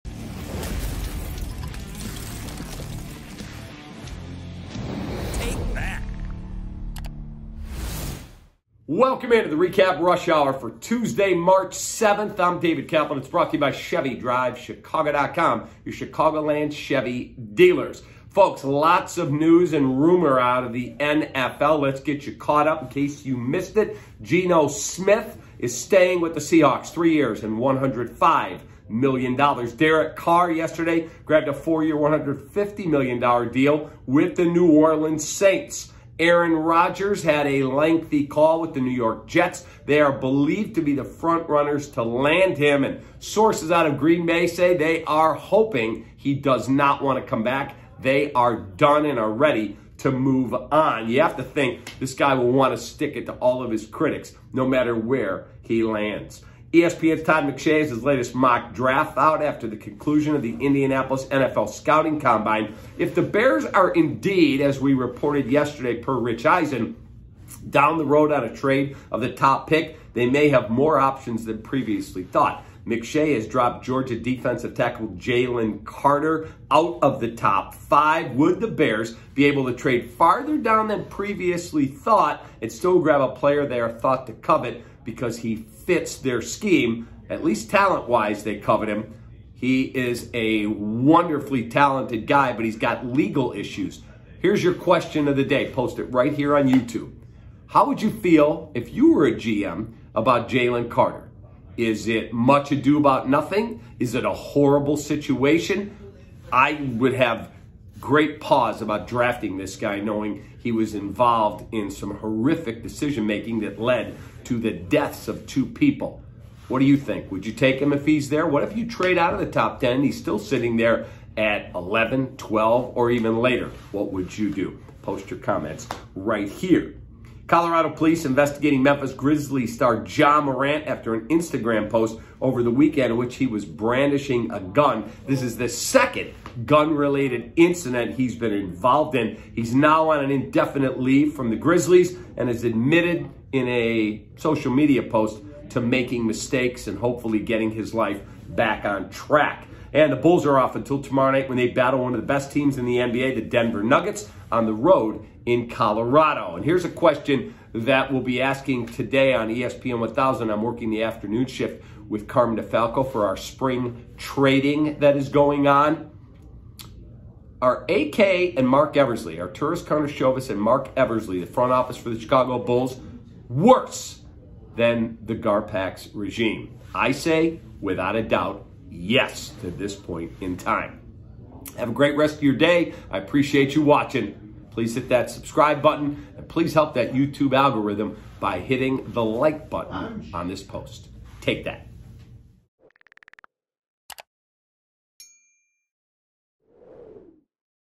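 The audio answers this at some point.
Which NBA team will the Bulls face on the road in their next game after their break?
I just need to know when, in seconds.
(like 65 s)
153 s.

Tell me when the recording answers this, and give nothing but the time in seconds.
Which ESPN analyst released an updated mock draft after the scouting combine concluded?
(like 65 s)
57 s.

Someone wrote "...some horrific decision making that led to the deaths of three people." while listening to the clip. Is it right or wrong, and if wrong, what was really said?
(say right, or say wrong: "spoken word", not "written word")
wrong: "two", not "three".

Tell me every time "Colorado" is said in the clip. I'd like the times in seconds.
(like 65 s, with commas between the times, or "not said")
127 s, 155 s.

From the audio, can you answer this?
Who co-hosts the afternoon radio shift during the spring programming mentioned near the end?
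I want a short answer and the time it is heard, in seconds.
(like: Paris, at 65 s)
Carmen DeFalco, at 162 s.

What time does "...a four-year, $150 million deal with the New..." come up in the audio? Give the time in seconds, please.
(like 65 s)
31 s.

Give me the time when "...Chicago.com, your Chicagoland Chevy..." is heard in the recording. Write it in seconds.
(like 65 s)
14 s.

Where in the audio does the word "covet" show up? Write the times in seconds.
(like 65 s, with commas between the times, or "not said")
84 s, 88 s.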